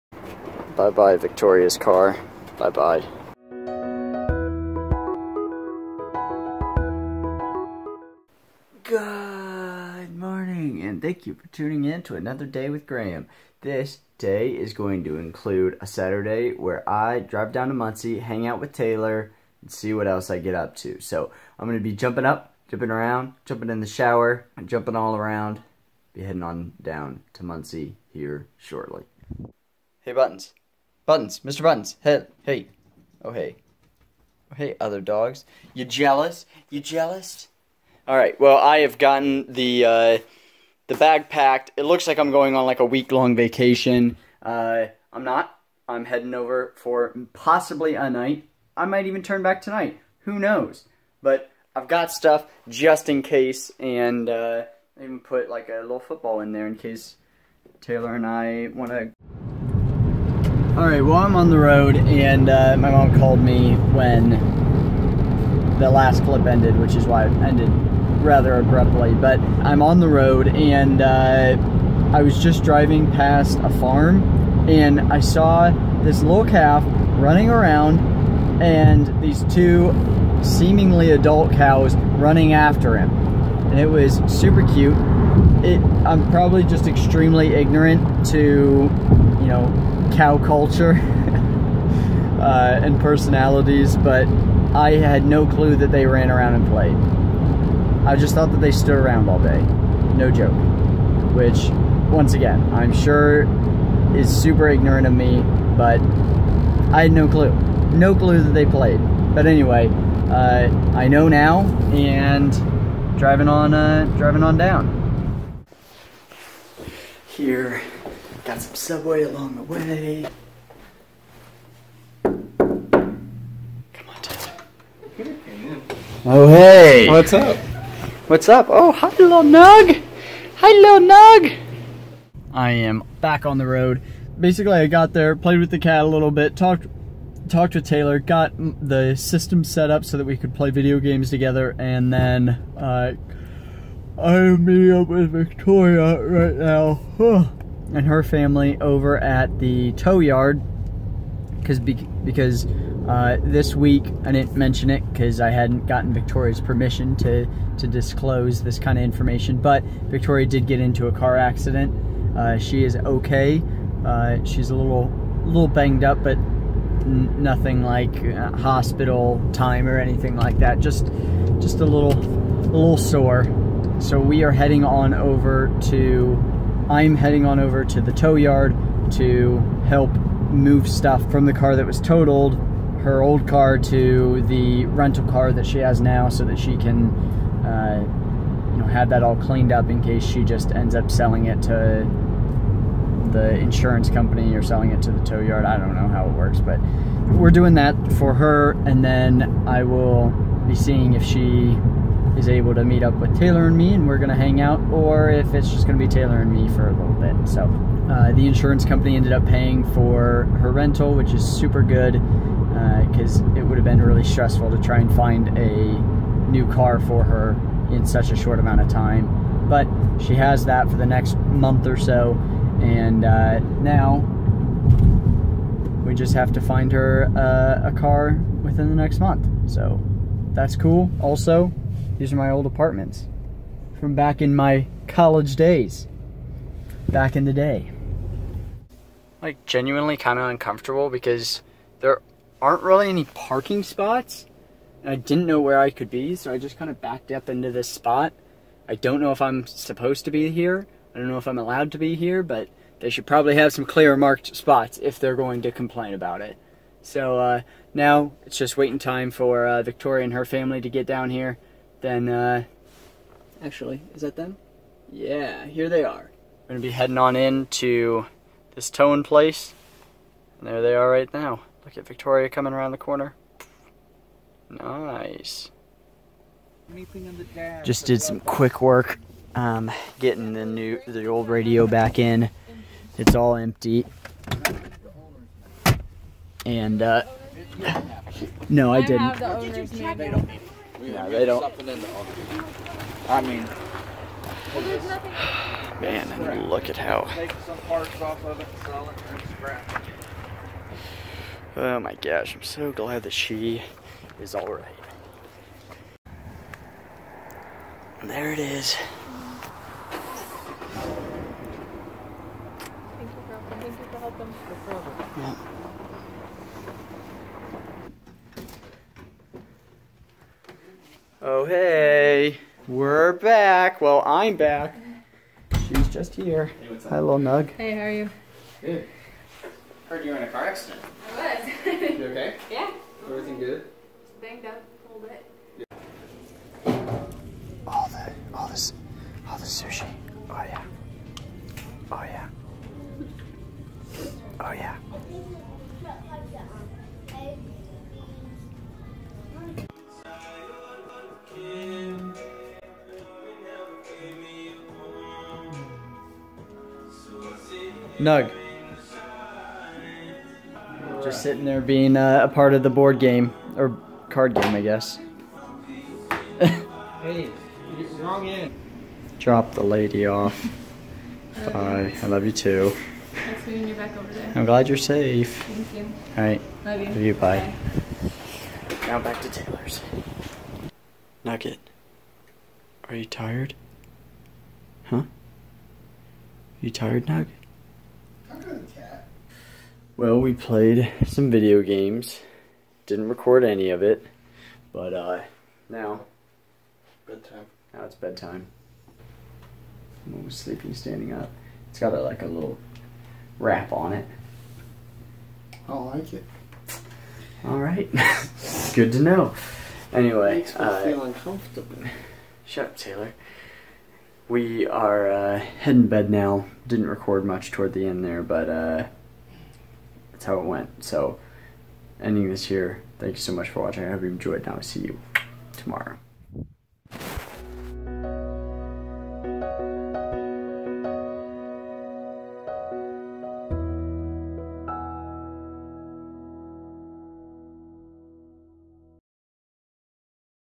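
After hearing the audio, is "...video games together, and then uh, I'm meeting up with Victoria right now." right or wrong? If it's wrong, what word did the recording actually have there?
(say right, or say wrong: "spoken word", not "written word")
right.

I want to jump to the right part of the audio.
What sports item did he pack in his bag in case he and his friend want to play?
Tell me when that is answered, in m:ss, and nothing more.
0:55.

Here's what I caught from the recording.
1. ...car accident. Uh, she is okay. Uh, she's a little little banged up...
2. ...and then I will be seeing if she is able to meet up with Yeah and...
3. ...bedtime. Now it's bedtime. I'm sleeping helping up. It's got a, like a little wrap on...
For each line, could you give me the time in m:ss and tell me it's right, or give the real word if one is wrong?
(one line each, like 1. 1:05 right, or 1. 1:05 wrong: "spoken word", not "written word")
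1. 2:41 right
2. 3:18 wrong: "Taylor", not "Yeah"
3. 6:37 wrong: "standing", not "helping".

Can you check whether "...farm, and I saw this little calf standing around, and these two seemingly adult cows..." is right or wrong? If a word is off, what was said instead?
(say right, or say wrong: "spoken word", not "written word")
wrong: "running", not "standing".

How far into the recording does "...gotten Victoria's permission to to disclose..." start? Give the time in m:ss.
2:35.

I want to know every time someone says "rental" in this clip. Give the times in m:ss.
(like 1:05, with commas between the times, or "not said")
3:04, 3:30.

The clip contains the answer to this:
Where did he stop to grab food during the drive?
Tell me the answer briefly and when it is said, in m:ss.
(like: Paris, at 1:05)
Subway, at 1:58.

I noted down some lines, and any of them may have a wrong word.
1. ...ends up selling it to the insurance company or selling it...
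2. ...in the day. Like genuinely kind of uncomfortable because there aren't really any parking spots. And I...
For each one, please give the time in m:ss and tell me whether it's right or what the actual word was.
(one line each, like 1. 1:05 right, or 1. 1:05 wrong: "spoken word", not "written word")
1. 3:10 right
2. 3:57 right.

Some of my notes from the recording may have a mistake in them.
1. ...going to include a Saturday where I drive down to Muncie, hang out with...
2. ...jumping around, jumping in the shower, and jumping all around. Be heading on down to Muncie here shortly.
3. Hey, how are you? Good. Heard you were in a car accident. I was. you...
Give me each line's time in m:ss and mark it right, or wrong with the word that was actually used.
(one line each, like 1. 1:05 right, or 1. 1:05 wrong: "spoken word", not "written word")
1. 0:14 right
2. 0:22 right
3. 5:27 right.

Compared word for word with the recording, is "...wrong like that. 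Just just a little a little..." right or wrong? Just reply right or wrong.
wrong.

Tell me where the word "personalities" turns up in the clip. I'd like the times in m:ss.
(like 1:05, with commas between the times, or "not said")
1:33.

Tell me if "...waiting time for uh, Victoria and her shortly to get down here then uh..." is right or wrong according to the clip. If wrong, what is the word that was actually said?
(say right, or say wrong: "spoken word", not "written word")
wrong: "family", not "shortly".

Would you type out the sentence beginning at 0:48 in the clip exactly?
I might even turn back tonight.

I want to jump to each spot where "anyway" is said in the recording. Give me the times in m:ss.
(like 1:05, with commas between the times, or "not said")
1:49, 6:50.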